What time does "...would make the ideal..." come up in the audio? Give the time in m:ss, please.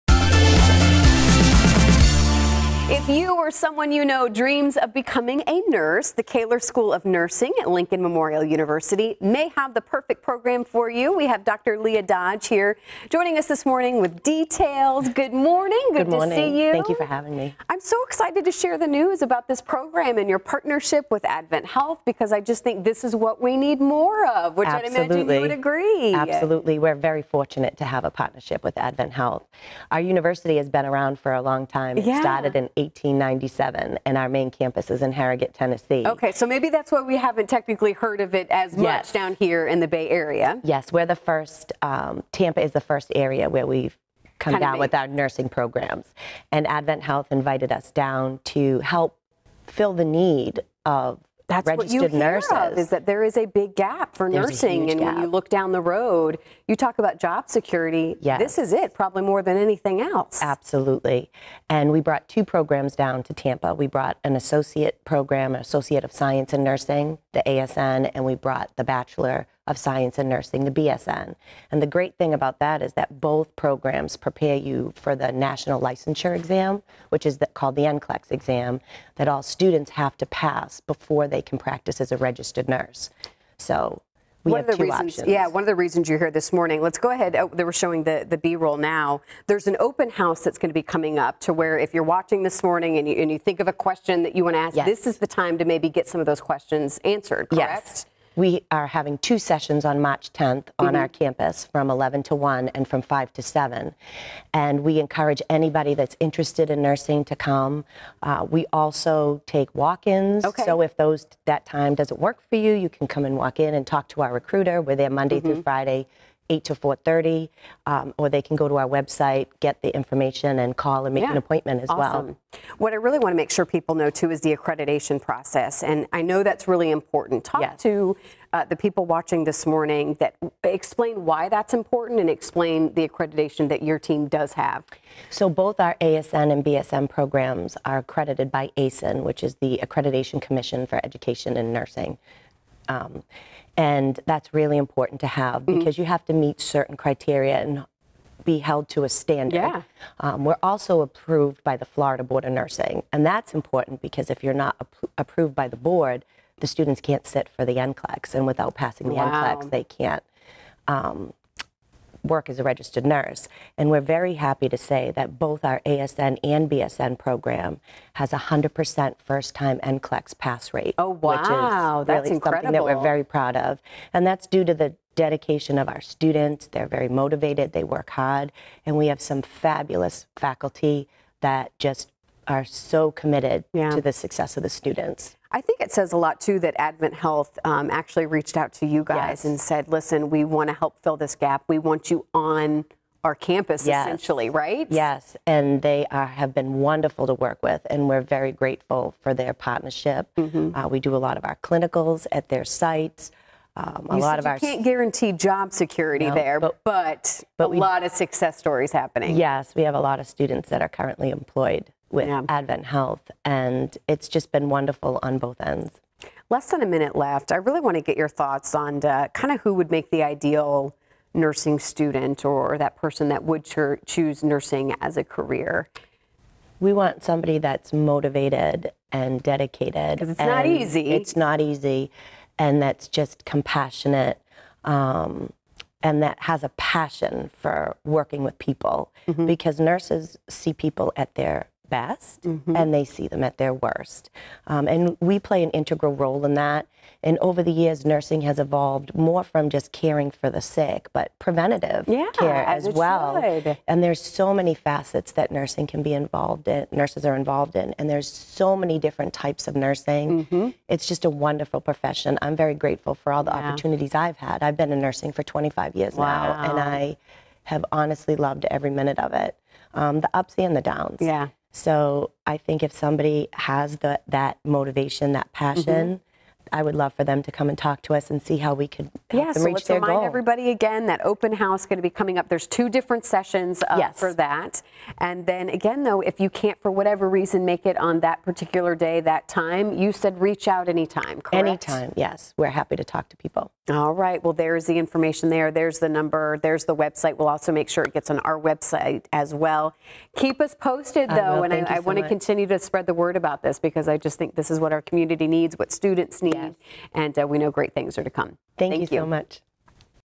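3:39.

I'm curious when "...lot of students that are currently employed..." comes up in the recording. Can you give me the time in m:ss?
3:30.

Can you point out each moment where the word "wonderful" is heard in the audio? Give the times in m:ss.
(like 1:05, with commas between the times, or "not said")
3:16, 3:34, 4:21.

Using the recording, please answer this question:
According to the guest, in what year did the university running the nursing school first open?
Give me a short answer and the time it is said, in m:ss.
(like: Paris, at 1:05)
1897, at 0:32.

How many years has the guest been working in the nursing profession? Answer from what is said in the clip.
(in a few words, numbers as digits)
25 years.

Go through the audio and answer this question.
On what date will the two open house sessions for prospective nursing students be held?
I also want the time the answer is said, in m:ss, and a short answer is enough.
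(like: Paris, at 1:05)
March 10th, at 1:40.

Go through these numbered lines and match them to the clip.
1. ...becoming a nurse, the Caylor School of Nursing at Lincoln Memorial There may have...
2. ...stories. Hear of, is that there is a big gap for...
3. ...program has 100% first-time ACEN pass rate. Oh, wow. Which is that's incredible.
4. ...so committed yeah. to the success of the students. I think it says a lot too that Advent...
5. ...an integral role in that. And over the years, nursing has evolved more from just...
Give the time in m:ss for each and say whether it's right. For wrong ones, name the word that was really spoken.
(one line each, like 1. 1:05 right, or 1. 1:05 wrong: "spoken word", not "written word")
1. 0:04 wrong: "University", not "There"
2. 0:52 wrong: "nurses", not "stories"
3. 2:47 wrong: "NCLEX", not "ACEN"
4. 3:02 right
5. 4:05 right.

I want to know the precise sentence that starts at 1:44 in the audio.
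And we encourage anybody that's interested in nursing to come.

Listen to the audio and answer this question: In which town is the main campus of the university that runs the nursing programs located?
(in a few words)
Harrogate, Tennessee.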